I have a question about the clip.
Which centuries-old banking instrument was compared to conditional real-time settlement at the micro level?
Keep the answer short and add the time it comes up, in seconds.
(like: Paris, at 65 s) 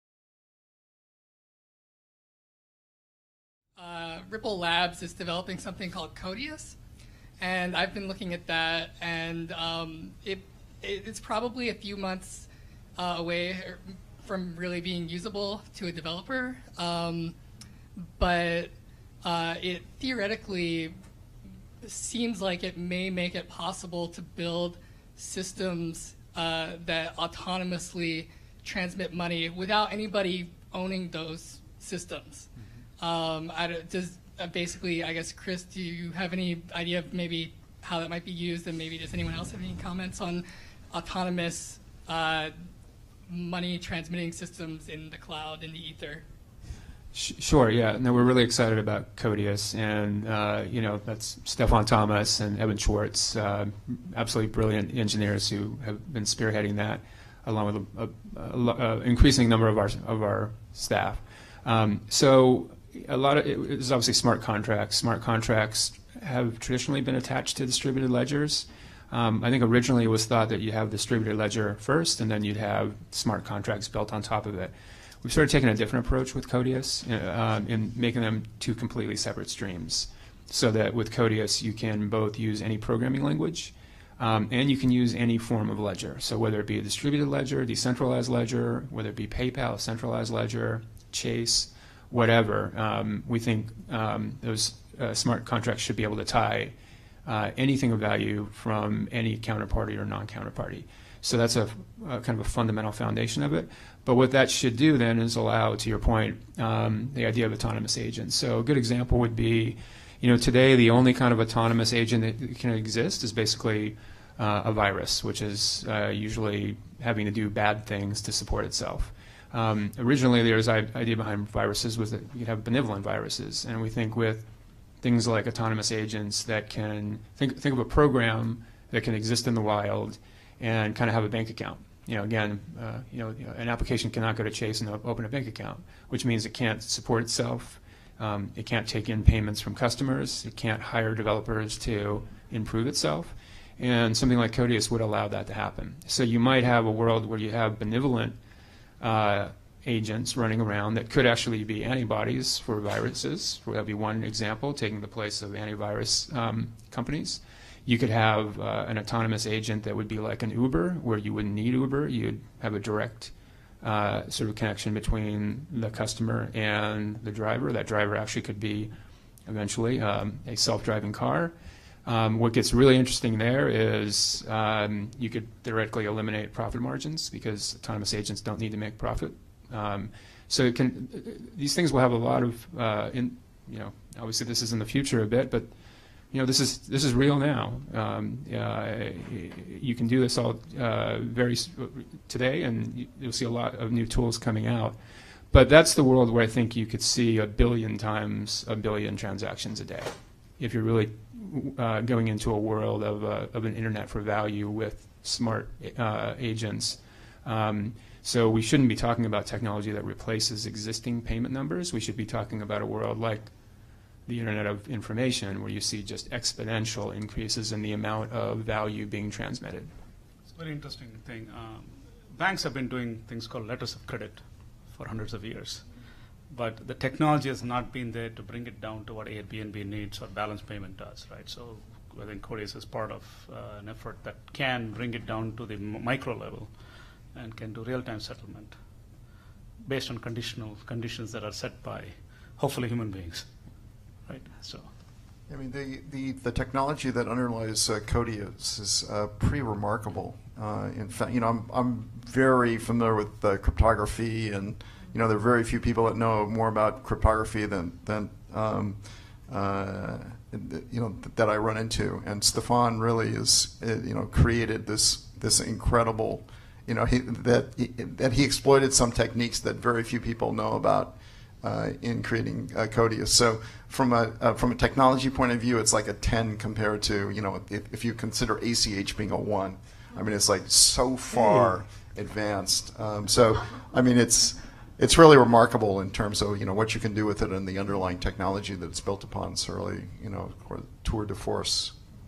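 letters of credit, at 223 s.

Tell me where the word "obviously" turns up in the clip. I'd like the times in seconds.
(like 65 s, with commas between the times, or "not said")
63 s, 184 s.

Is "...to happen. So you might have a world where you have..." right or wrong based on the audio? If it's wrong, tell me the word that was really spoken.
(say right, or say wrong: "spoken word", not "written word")
right.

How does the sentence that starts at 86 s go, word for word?
So whether it be a distributed ledger, decentralized ledger, whether it be PayPal, centralized ledger, Chase, whatever.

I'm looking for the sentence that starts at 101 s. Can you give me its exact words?
So that's a, a, kind of a fundamental foundation of it.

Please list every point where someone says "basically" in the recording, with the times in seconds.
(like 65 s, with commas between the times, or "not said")
34 s, 113 s.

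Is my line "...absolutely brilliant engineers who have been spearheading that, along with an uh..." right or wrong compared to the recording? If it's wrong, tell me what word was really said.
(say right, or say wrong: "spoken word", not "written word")
right.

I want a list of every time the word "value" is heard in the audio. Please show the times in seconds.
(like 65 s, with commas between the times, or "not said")
97 s, 204 s, 218 s.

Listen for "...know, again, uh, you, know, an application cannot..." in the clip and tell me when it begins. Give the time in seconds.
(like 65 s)
132 s.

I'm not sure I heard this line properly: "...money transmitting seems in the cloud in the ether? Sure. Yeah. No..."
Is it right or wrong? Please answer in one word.
wrong.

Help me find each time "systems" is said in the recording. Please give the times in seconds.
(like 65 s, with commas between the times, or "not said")
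25 s, 31 s, 44 s.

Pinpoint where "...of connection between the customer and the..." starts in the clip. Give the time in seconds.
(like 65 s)
164 s.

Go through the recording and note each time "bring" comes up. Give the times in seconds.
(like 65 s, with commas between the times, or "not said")
228 s, 234 s.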